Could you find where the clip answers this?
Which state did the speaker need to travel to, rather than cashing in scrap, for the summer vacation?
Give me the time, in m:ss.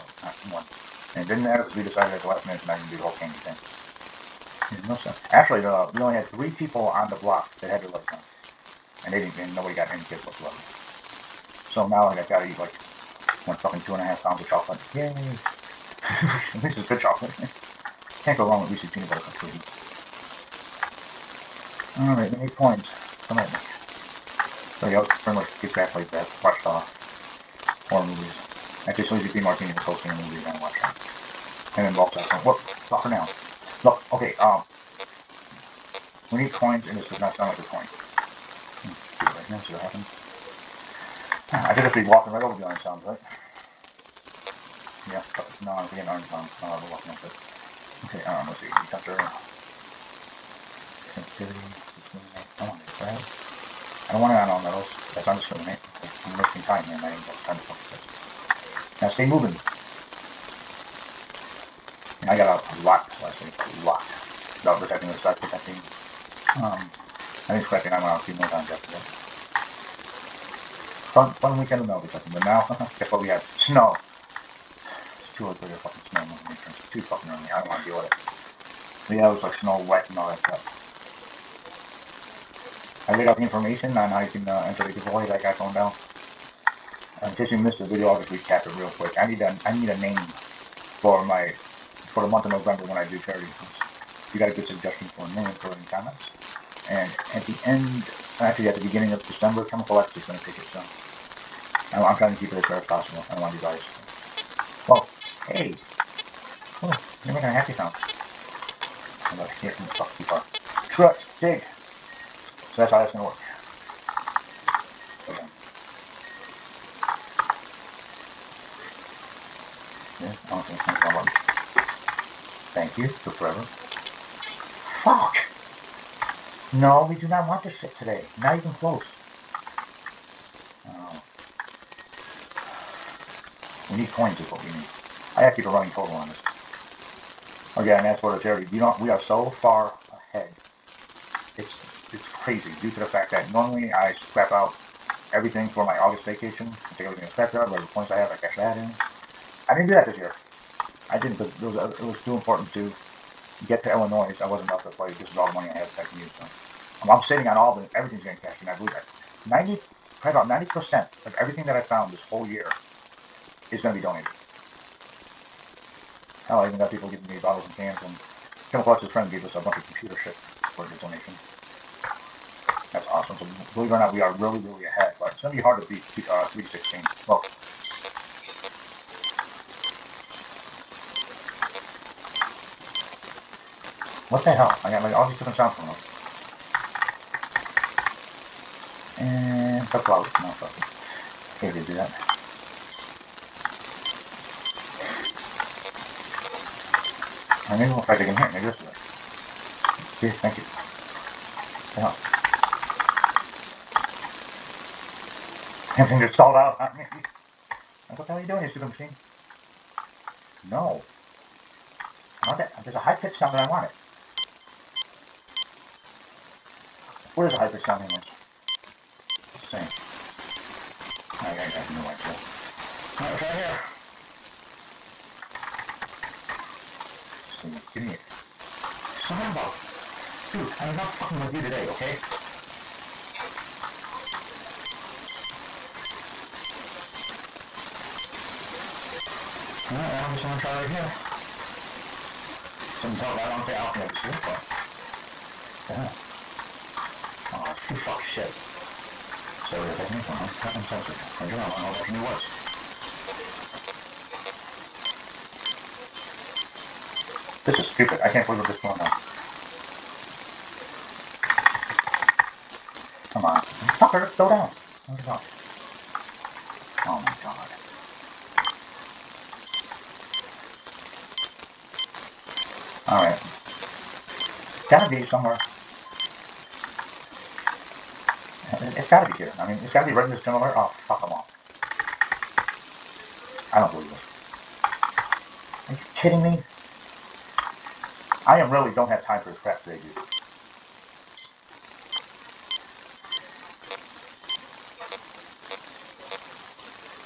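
2:33.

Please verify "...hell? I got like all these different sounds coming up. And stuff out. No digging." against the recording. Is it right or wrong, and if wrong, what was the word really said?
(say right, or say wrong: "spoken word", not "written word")
wrong: "fucking", not "digging".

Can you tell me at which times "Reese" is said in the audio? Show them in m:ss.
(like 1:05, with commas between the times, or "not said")
0:18.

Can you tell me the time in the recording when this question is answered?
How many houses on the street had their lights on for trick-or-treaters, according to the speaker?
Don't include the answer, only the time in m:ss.
0:06.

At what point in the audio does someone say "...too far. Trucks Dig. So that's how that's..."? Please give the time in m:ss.
1:50.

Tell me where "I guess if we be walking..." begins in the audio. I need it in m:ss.
0:41.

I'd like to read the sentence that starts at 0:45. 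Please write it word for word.
Yeah, no, we get getting iron sound.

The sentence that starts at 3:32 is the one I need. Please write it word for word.
There's a high-pitched sound that I want it.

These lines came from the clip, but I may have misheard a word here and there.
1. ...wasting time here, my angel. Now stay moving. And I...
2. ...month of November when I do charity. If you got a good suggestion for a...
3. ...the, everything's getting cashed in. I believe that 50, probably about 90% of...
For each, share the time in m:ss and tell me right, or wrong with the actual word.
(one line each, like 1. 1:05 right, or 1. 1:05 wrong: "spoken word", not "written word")
1. 0:56 right
2. 1:32 right
3. 2:37 wrong: "90", not "50".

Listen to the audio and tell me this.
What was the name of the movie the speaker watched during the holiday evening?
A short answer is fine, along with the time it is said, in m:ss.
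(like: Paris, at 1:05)
Sleazy Bean Martini, at 0:29.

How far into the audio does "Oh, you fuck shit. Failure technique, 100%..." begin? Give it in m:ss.
4:07.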